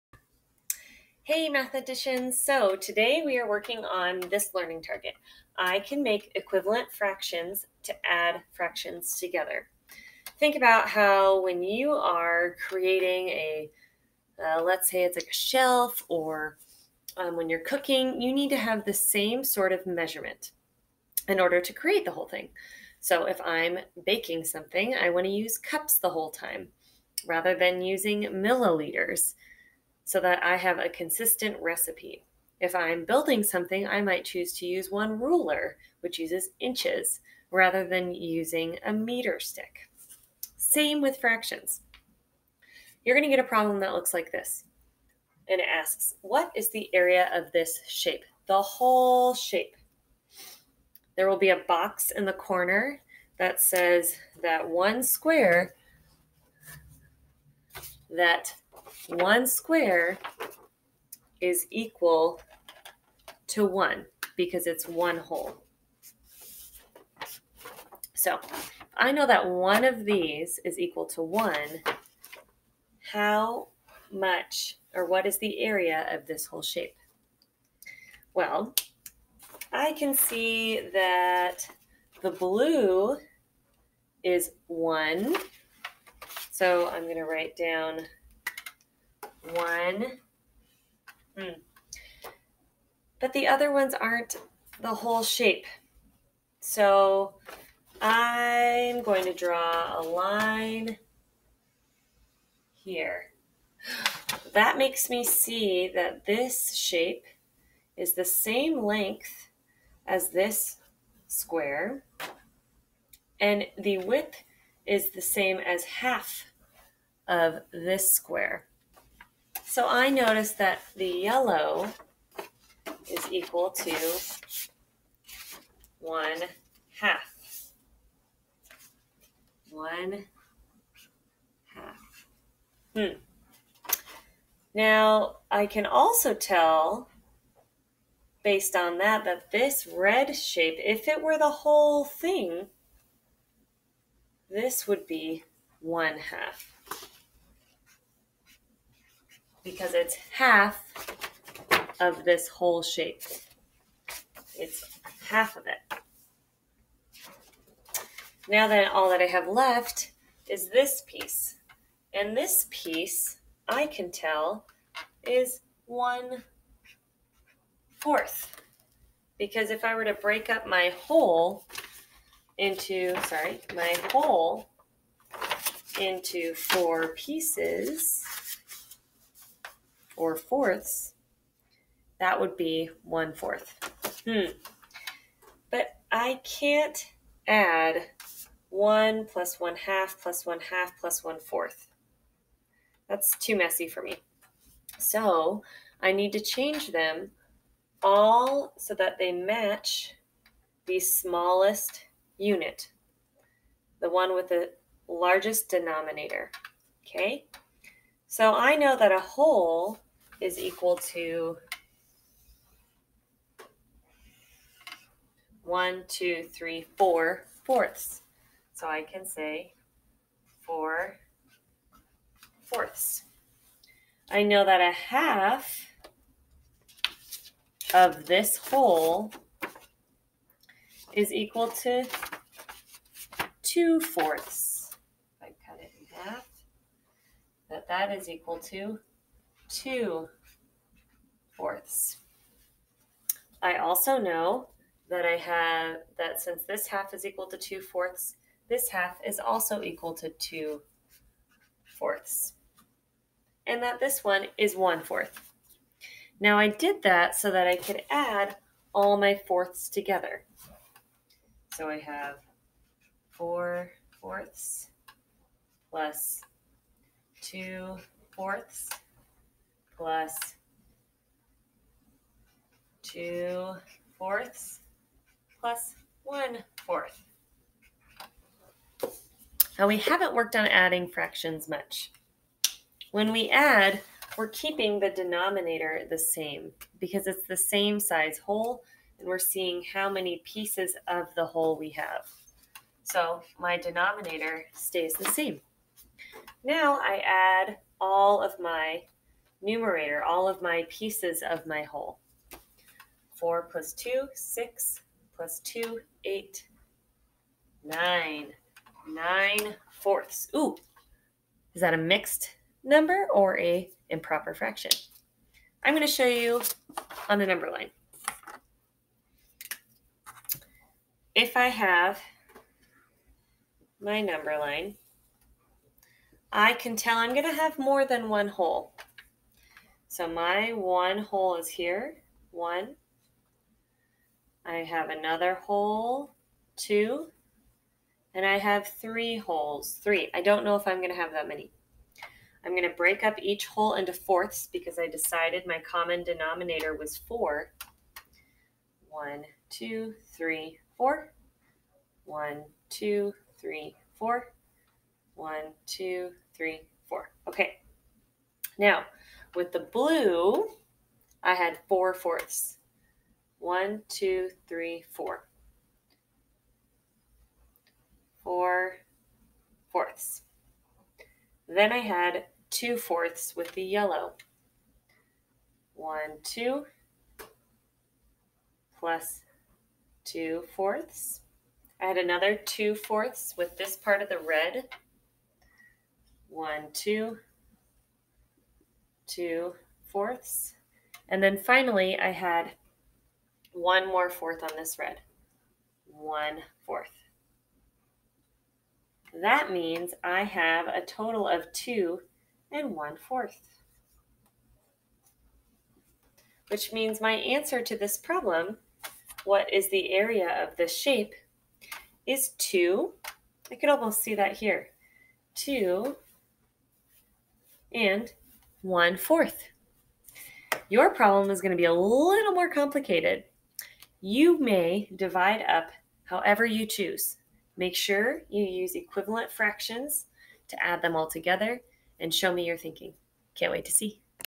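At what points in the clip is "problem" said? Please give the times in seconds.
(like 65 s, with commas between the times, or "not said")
43 s, 408 s, 421 s.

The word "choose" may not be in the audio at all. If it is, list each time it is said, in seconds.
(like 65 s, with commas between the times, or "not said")
34 s, 426 s.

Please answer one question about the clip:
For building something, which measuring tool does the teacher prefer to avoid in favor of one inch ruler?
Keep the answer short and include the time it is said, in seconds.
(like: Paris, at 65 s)
meter stick, at 38 s.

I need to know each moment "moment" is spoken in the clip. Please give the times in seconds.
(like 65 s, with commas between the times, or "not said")
not said.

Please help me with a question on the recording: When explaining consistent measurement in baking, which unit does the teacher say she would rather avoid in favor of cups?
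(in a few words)
milliliters.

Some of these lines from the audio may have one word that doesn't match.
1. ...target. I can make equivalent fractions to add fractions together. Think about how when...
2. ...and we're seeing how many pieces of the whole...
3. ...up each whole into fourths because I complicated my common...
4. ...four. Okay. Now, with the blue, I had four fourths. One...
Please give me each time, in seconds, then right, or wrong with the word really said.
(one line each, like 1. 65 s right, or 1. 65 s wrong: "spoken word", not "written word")
1. 4 s right
2. 289 s right
3. 343 s wrong: "decided", not "complicated"
4. 357 s right.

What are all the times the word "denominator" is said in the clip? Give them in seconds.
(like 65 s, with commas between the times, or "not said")
205 s, 285 s, 293 s, 346 s.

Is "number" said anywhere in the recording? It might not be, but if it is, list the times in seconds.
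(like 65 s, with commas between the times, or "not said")
312 s, 317 s, 324 s.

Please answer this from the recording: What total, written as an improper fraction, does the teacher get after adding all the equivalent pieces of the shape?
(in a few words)
9/4.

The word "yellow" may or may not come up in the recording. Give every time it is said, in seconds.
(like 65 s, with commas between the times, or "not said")
121 s, 373 s.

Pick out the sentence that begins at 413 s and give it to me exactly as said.
I could almost see that here.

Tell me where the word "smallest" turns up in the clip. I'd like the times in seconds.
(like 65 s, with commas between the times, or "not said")
200 s.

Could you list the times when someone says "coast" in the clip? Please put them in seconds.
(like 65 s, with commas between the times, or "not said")
not said.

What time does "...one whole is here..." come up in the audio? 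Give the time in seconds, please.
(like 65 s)
330 s.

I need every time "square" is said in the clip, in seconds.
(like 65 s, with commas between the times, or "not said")
55 s, 59 s, 111 s, 118 s.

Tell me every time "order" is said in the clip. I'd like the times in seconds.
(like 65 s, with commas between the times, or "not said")
21 s.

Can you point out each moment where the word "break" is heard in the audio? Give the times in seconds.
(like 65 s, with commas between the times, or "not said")
170 s, 342 s.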